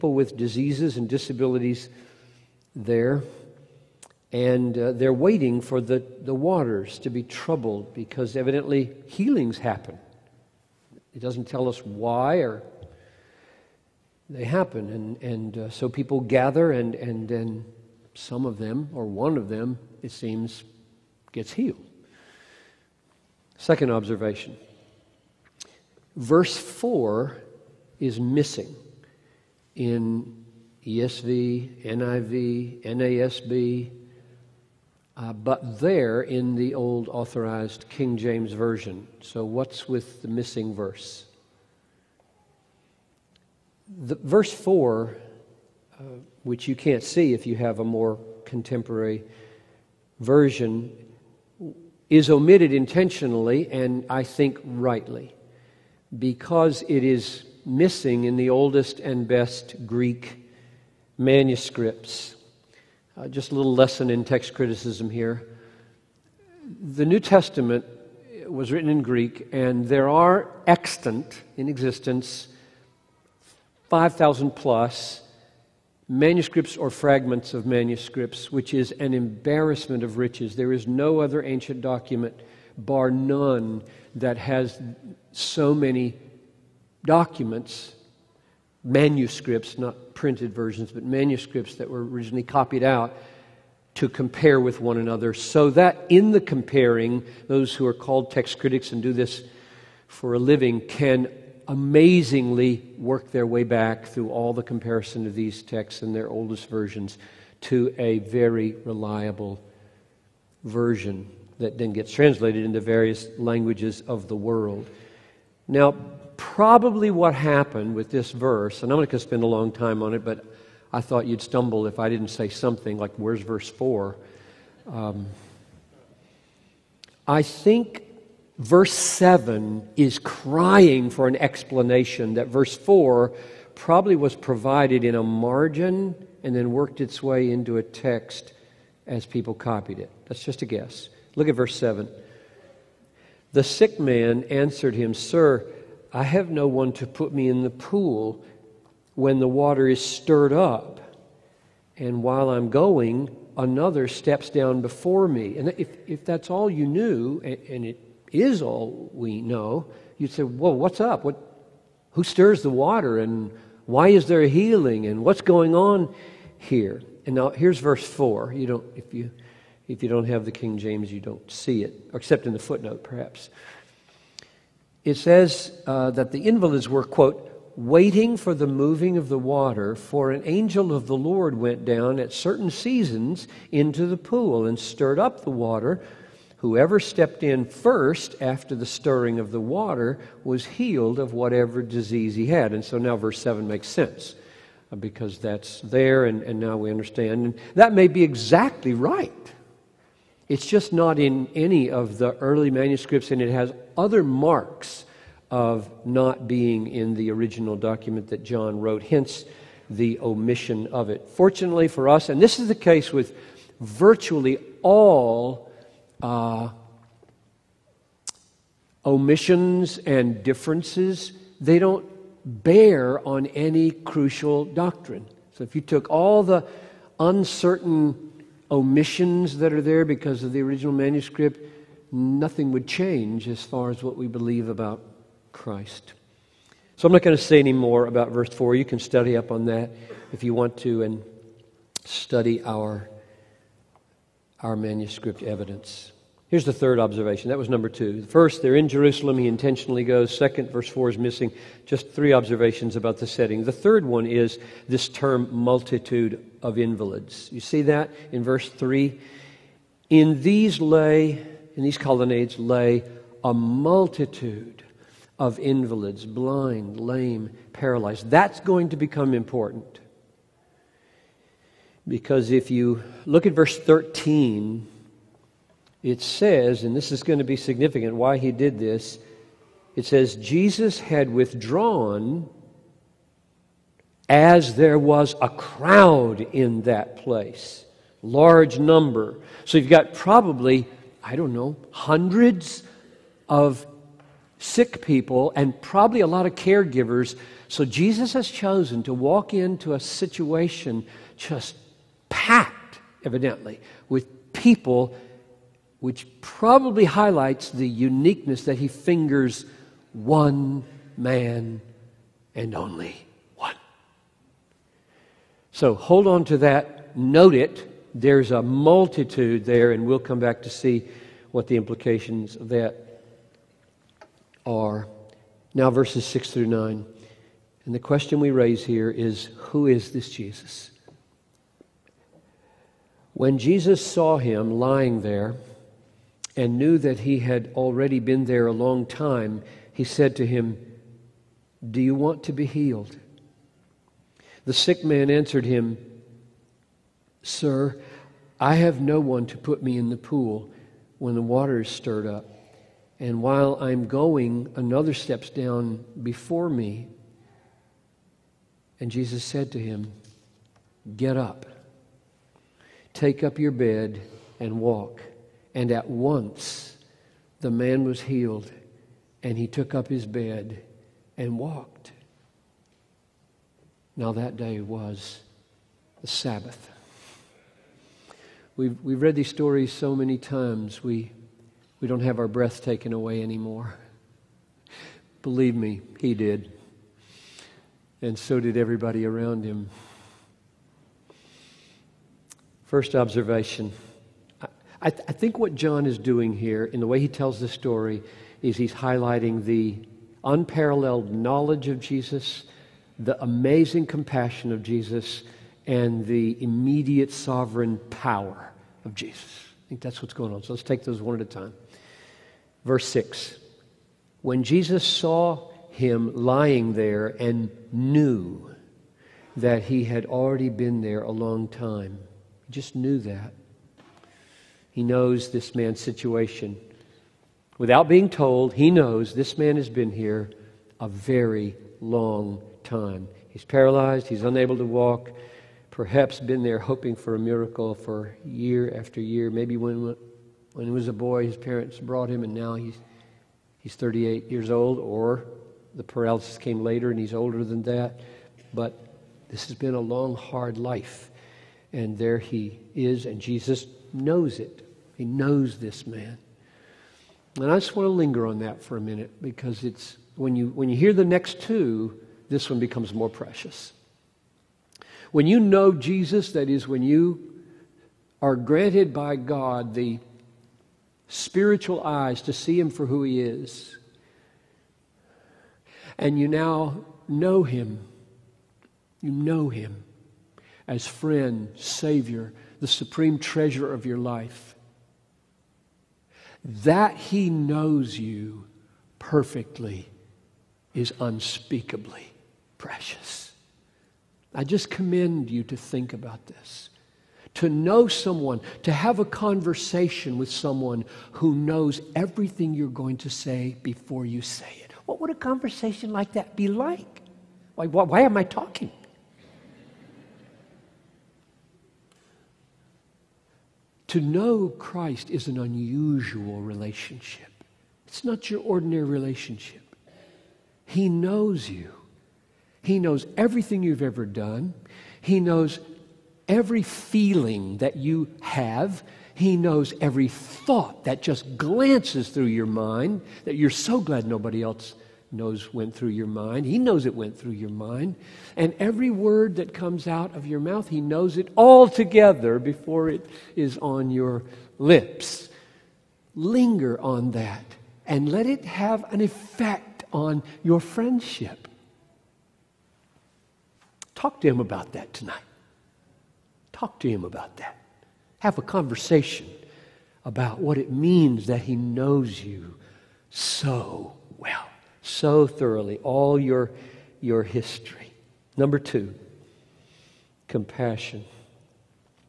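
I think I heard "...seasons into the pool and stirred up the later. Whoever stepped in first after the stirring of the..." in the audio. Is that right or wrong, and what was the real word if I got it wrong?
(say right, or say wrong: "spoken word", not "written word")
wrong: "water", not "later".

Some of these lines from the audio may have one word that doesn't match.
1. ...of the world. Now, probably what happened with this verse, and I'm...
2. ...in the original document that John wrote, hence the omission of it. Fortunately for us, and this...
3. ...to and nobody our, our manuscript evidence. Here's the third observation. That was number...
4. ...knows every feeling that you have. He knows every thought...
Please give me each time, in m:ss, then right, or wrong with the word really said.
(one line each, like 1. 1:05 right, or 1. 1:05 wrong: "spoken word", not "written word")
1. 1:54 right
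2. 3:26 right
3. 4:00 wrong: "study", not "nobody"
4. 8:45 right.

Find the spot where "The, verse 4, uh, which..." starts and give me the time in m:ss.
0:44.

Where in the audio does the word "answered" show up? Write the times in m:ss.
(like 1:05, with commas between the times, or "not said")
2:24, 5:45.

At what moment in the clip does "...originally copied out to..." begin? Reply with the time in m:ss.
1:32.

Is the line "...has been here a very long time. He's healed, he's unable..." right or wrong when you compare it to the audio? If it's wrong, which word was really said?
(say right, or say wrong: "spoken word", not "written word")
wrong: "paralyzed", not "healed".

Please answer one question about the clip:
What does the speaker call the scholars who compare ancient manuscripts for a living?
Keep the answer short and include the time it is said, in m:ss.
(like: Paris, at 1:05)
text critics, at 1:38.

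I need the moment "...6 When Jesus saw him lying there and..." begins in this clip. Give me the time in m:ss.
6:53.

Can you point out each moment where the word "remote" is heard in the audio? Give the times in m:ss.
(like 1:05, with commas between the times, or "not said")
not said.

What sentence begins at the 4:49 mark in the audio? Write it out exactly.
So you've got probably, I don't know, hundreds of sick people and probably a lot of caregivers.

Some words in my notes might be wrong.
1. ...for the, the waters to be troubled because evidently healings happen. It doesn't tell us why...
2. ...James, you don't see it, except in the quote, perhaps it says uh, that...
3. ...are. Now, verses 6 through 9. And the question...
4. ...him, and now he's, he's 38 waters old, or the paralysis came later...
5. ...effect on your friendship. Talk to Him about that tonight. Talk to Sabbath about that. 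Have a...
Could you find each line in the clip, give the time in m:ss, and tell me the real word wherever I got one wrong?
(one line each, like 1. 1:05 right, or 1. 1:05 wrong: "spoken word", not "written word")
1. 0:05 right
2. 2:50 wrong: "footnote", not "quote"
3. 5:24 right
4. 7:22 wrong: "years", not "waters"
5. 9:09 wrong: "Him", not "Sabbath".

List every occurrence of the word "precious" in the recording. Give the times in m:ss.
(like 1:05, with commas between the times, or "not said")
7:43, 8:12.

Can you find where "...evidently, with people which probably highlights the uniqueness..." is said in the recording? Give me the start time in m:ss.
5:03.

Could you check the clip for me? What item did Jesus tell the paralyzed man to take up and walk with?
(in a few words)
his bed.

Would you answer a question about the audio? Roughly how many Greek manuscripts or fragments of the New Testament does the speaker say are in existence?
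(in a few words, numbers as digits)
5,000 plus.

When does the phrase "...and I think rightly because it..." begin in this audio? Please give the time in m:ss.
0:53.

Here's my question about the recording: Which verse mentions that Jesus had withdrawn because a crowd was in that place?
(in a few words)
Verse 13.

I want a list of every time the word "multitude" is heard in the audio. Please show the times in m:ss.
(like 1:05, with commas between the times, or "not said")
4:15, 4:23, 5:18.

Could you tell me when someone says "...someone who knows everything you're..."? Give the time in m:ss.
8:20.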